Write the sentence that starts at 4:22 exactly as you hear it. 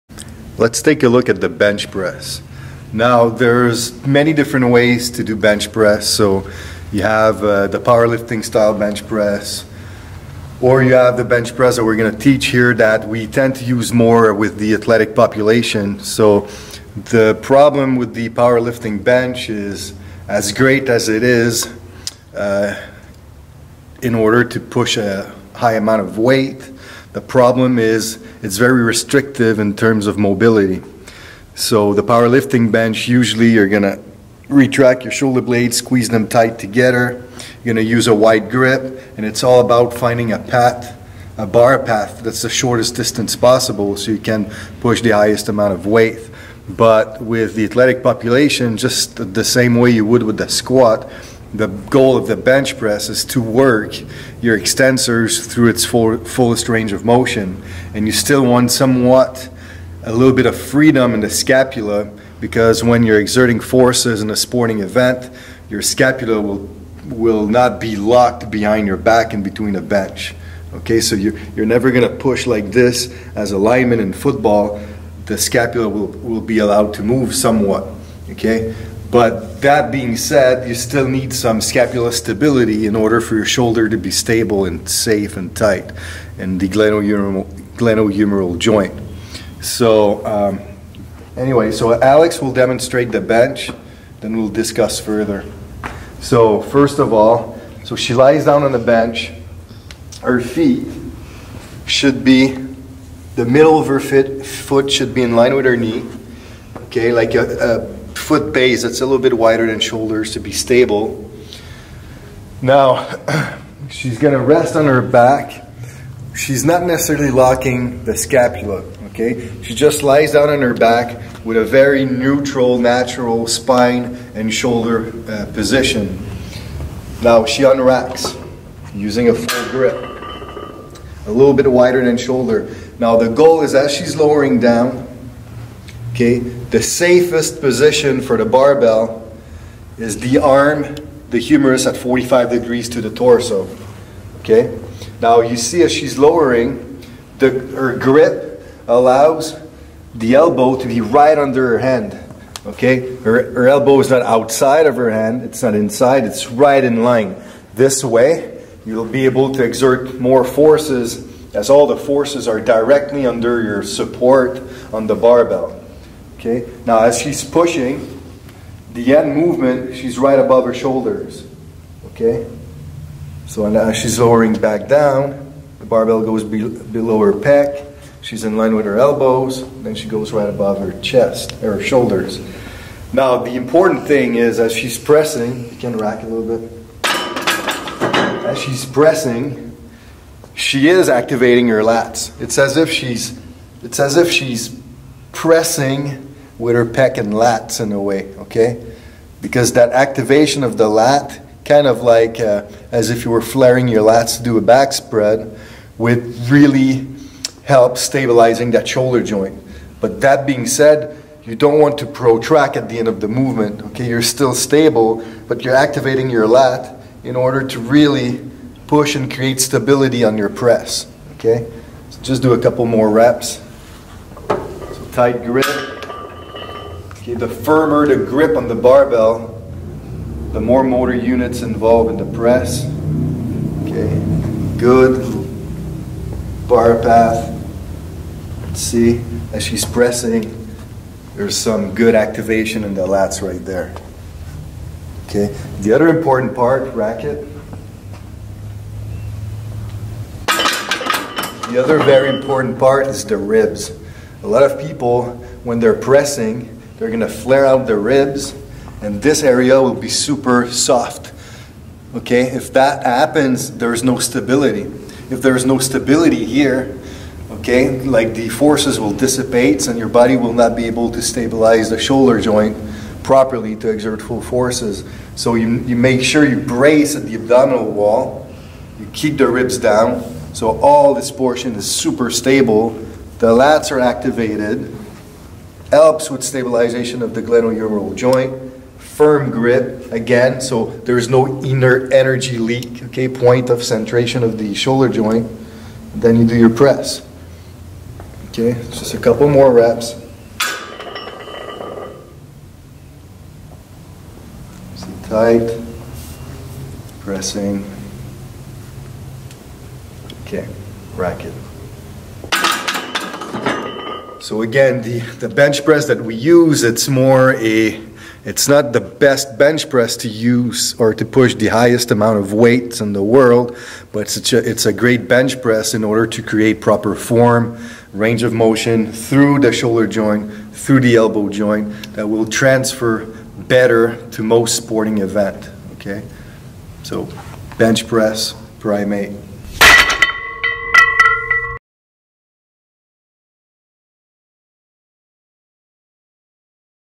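Okay, if that happens, there is no stability.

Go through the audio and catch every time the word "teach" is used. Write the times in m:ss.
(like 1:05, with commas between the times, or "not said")
0:12.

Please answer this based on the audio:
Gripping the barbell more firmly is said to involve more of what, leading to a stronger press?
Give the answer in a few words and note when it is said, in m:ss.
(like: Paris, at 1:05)
Motor units, at 3:50.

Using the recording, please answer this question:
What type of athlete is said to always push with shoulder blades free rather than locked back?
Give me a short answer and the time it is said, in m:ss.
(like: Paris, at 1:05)
Lineman in football, at 1:13.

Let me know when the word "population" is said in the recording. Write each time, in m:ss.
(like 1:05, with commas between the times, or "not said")
0:15, 0:48.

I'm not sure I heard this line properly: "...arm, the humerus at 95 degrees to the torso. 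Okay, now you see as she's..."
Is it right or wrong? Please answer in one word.
wrong.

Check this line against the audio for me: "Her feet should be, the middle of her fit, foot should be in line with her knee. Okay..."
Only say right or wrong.
right.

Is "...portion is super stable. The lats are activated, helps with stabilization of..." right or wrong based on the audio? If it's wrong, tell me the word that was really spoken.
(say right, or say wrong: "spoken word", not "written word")
right.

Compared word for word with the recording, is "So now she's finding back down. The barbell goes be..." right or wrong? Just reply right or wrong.
wrong.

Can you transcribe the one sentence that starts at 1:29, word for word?
So um, anyway, so Alex will demonstrate the bench, then we'll discuss further.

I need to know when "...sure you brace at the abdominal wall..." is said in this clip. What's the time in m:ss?
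4:36.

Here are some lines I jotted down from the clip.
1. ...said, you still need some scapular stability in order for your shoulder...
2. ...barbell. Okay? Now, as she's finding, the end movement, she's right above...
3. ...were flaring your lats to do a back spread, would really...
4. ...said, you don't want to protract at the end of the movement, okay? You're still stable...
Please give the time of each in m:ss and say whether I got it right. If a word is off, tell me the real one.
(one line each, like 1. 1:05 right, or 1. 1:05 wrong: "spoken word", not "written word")
1. 1:20 right
2. 2:45 wrong: "pushing", not "finding"
3. 3:23 right
4. 3:30 right.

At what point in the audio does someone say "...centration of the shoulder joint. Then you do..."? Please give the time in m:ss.
4:53.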